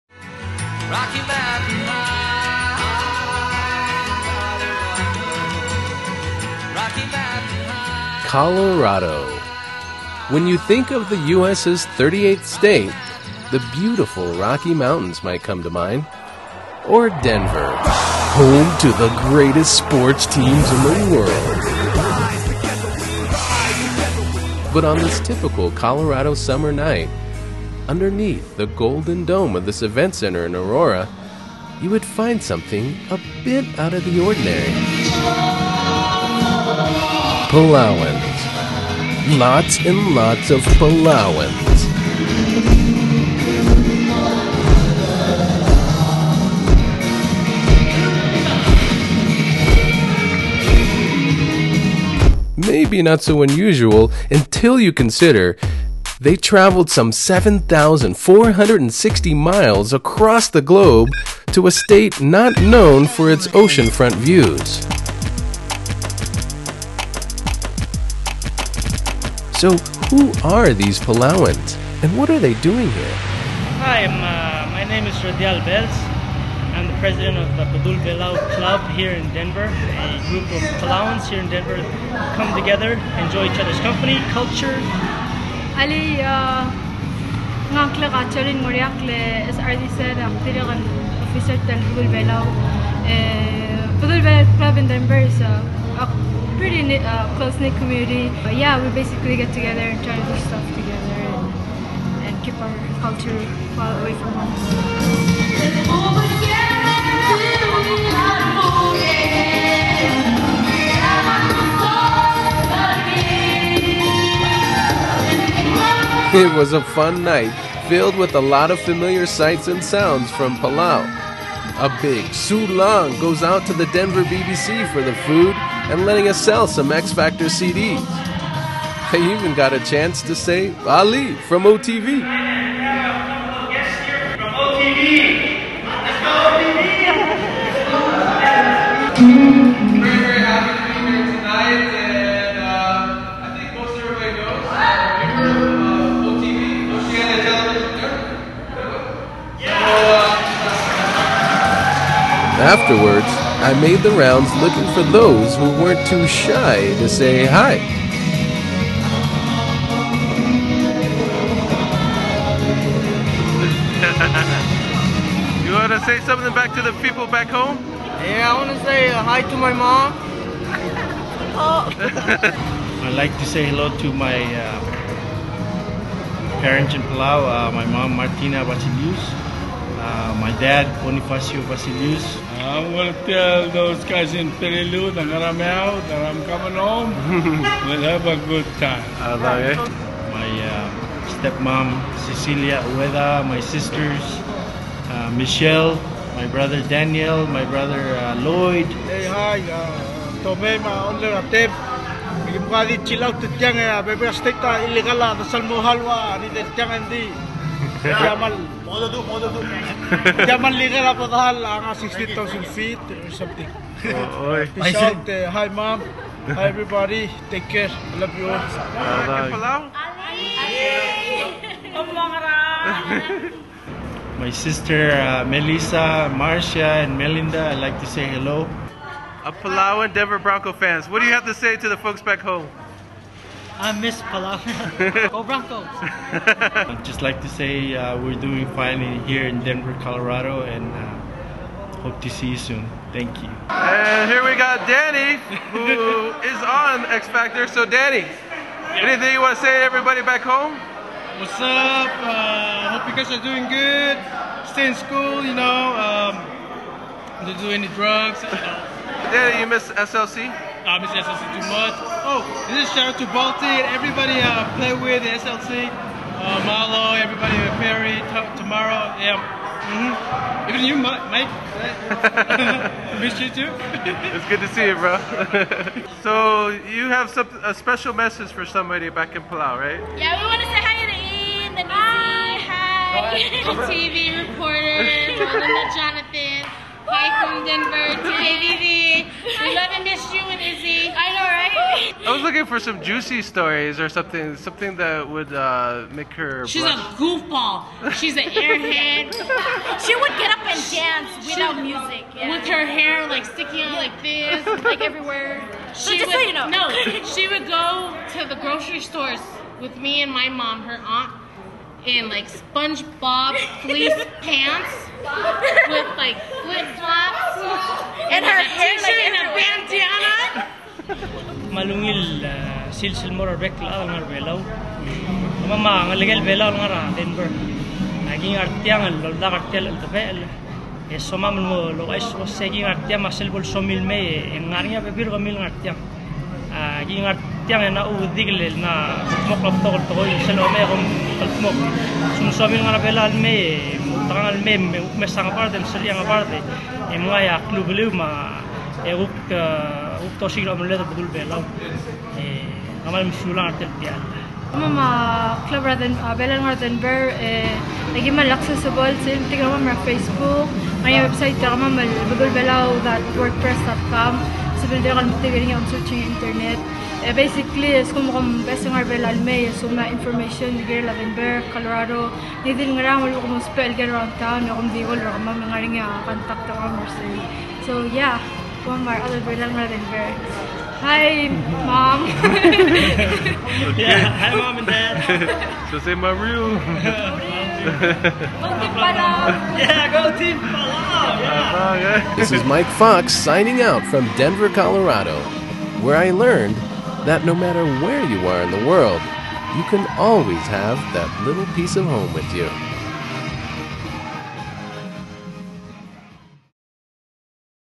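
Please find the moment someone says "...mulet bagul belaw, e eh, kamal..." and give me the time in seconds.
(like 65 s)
350 s.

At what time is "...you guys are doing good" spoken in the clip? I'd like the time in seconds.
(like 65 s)
253 s.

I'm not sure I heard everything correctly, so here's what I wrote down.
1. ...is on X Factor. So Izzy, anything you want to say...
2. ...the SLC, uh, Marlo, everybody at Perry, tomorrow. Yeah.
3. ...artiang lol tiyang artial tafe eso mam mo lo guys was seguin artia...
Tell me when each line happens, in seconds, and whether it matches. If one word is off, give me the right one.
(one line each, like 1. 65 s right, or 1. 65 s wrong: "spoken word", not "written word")
1. 246 s wrong: "Danny", not "Izzy"
2. 265 s right
3. 328 s wrong: "artiang", not "tiyang".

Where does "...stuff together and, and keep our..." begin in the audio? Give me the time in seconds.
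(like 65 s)
100 s.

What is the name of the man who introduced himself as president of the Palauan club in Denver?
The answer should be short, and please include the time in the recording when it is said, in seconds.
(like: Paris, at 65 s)
Radial Belz, at 75 s.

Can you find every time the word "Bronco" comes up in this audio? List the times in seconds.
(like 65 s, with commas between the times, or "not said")
230 s, 235 s.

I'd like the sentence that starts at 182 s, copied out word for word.
I uh, want to tell those guys in Peleliu, that I'm Nangaramel, that I'm coming home.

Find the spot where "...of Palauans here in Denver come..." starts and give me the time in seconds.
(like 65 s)
80 s.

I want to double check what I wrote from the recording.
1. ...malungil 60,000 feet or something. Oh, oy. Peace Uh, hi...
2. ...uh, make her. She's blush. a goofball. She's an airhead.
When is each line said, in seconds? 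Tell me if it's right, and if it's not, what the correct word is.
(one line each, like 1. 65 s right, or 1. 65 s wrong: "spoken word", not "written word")
1. 211 s wrong: "dahil", not "malungil"
2. 295 s right.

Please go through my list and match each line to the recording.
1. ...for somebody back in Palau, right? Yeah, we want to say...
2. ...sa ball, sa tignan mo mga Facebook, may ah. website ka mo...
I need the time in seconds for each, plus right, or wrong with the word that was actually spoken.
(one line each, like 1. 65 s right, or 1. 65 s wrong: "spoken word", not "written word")
1. 278 s right
2. 358 s right.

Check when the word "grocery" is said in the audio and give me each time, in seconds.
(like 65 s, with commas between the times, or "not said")
308 s.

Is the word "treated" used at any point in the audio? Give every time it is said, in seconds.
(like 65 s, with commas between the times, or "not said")
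not said.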